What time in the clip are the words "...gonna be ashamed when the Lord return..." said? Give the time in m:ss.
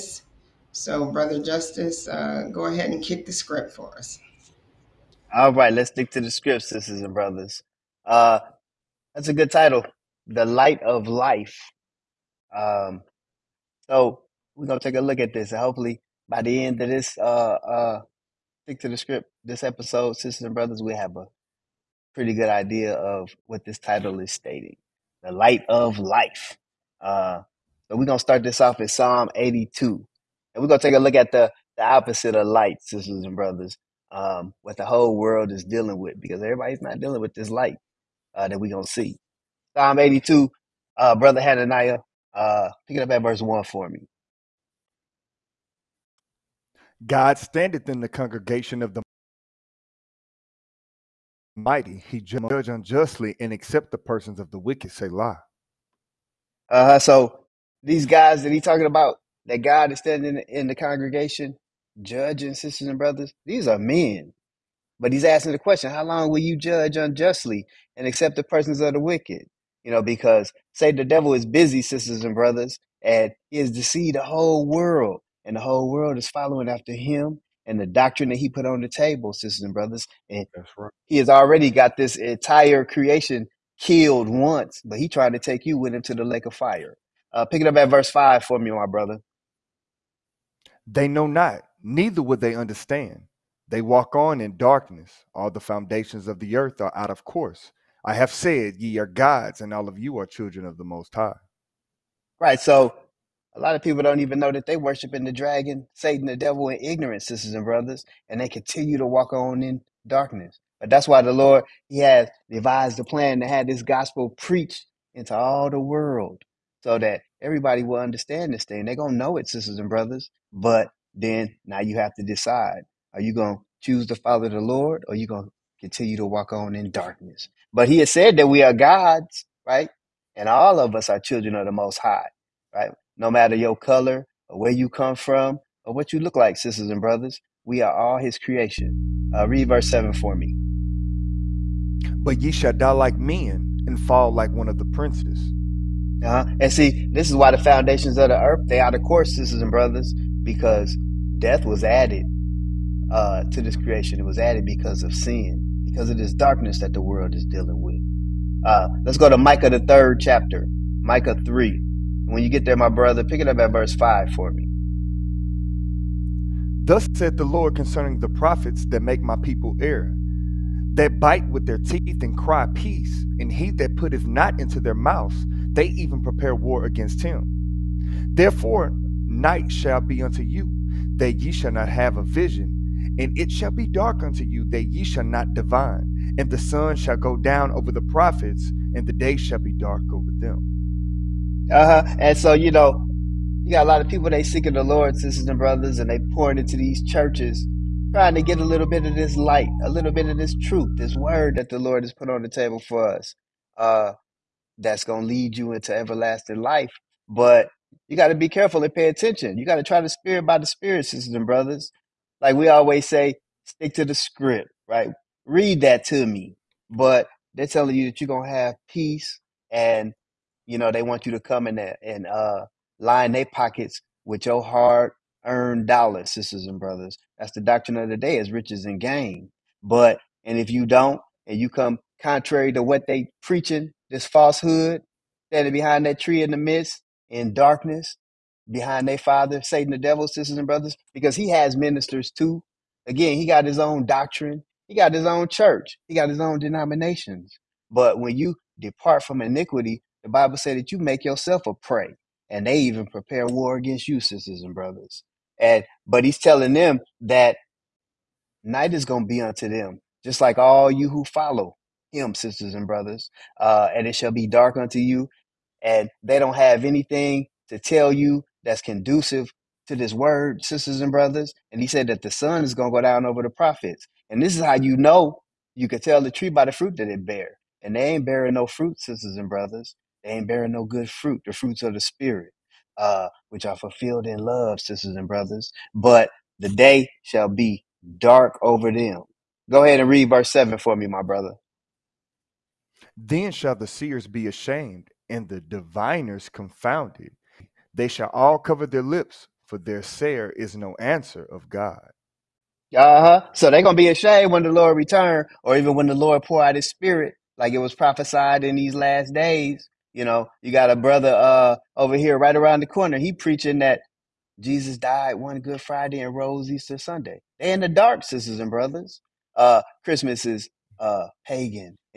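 5:03.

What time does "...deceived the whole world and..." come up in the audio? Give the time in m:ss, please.
1:13.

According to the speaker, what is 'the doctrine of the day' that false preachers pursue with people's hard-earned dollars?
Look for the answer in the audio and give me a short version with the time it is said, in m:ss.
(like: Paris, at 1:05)
riches and gain, at 3:48.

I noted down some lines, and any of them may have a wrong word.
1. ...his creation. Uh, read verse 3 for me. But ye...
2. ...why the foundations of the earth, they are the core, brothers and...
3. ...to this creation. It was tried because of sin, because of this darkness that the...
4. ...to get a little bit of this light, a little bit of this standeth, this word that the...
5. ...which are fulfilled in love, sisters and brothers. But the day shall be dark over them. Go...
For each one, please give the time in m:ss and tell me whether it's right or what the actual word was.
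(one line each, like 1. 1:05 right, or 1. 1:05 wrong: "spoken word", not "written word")
1. 2:18 wrong: "7", not "3"
2. 2:27 wrong: "sisters", not "brothers"
3. 2:33 wrong: "added", not "tried"
4. 3:18 wrong: "truth", not "standeth"
5. 4:43 right.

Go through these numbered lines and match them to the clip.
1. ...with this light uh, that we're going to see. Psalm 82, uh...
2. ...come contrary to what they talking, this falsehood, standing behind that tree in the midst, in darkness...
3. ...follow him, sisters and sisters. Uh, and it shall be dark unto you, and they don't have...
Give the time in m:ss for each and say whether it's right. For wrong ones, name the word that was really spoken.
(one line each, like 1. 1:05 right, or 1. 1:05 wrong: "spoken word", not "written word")
1. 0:37 right
2. 3:51 wrong: "preaching", not "talking"
3. 4:21 wrong: "brothers", not "sisters".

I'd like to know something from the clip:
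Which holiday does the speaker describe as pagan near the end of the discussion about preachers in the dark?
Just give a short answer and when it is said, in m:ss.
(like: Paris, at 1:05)
Christmas, at 5:20.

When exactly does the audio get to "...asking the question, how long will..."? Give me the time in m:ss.
1:05.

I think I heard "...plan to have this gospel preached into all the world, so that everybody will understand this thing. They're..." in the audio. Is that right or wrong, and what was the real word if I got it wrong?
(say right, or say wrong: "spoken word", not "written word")
right.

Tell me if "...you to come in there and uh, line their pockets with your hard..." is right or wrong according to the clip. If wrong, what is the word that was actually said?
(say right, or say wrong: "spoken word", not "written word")
right.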